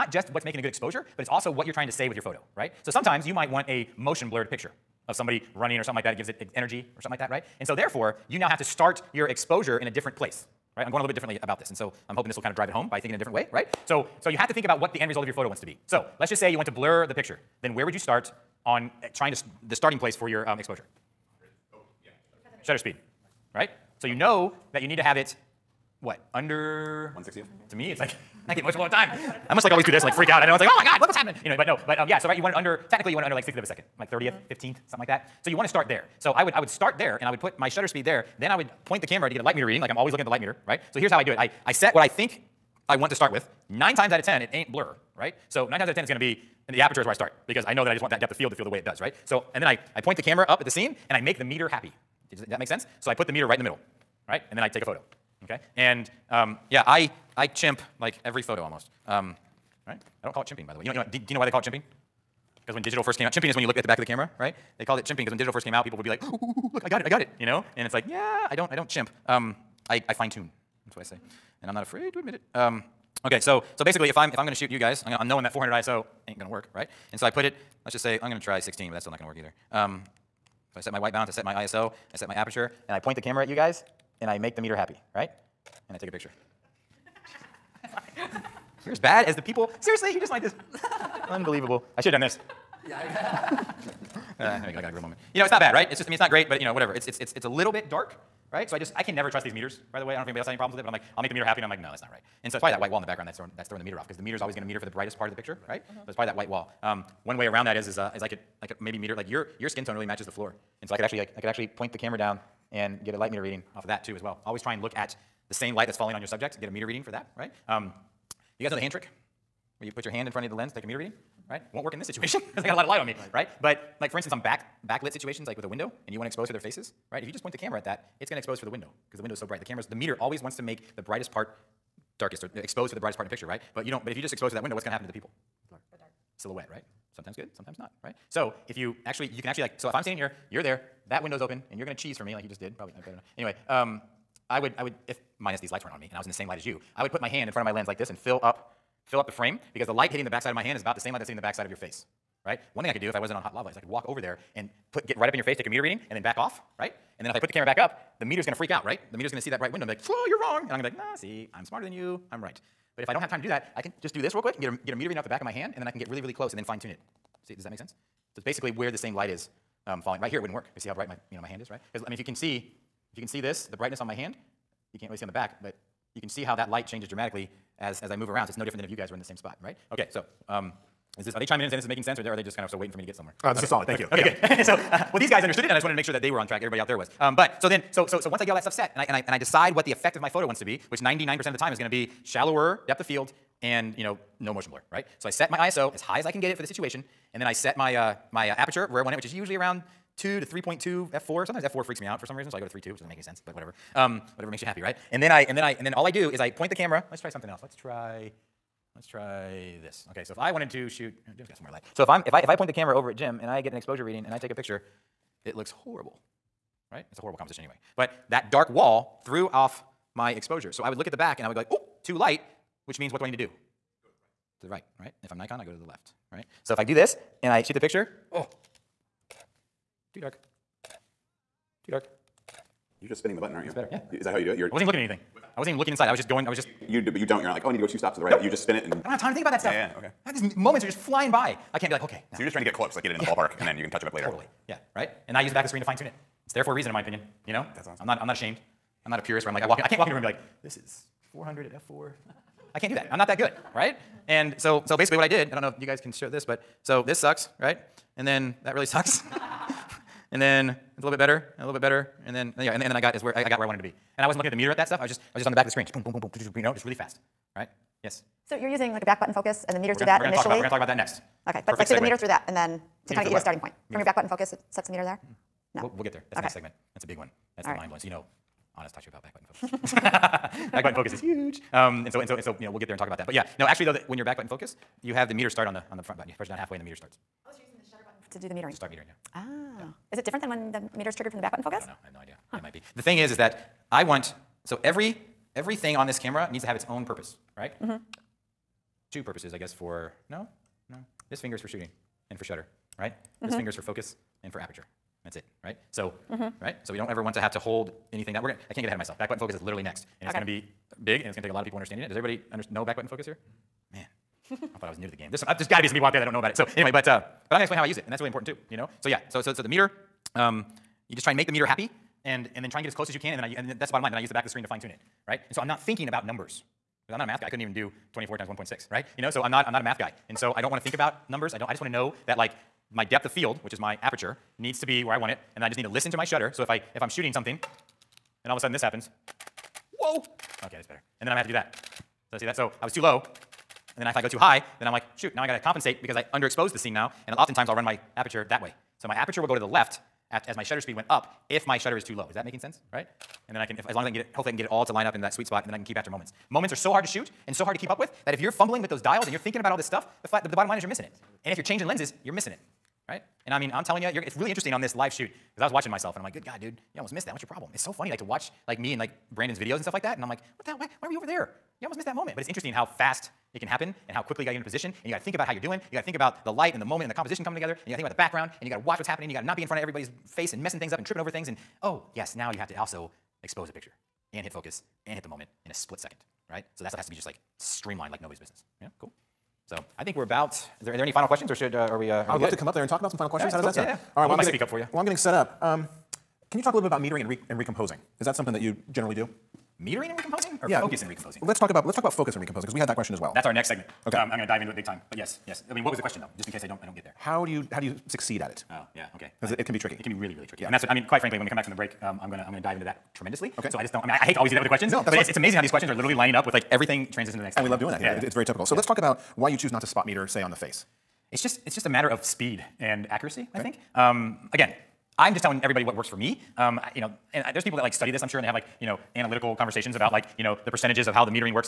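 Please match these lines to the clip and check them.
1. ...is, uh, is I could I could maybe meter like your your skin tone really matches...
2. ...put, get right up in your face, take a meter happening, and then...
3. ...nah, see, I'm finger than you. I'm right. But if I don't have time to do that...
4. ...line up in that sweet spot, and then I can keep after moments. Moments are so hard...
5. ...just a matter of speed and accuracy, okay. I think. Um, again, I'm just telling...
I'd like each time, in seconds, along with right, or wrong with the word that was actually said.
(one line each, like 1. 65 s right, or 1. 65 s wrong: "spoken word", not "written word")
1. 107 s right
2. 154 s wrong: "reading", not "happening"
3. 160 s wrong: "smarter", not "finger"
4. 354 s right
5. 421 s right.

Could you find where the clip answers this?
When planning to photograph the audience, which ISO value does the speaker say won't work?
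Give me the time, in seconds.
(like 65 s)
75 s.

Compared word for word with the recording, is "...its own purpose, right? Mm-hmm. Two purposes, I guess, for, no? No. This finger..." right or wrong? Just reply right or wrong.
right.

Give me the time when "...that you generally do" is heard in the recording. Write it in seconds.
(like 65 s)
398 s.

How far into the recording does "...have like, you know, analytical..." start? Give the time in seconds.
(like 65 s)
428 s.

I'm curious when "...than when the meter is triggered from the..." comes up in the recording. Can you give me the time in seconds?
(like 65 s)
290 s.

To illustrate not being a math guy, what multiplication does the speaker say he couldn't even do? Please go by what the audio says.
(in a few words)
24 times 1.6.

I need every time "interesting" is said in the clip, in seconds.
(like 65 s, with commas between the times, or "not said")
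364 s, 372 s.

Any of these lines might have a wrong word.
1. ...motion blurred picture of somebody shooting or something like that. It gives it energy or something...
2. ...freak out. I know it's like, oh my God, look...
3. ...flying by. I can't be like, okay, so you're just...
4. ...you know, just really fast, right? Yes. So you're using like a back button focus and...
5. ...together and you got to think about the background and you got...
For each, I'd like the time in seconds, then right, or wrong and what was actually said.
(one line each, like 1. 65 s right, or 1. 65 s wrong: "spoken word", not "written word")
1. 3 s wrong: "running", not "shooting"
2. 30 s right
3. 240 s right
4. 266 s right
5. 377 s right.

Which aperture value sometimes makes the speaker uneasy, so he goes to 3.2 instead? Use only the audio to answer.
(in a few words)
f4.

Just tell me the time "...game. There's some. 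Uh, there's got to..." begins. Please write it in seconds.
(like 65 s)
315 s.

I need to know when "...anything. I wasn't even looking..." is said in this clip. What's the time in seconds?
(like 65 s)
235 s.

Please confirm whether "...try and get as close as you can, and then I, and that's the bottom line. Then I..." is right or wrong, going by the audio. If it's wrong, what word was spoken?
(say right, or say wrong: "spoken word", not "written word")
right.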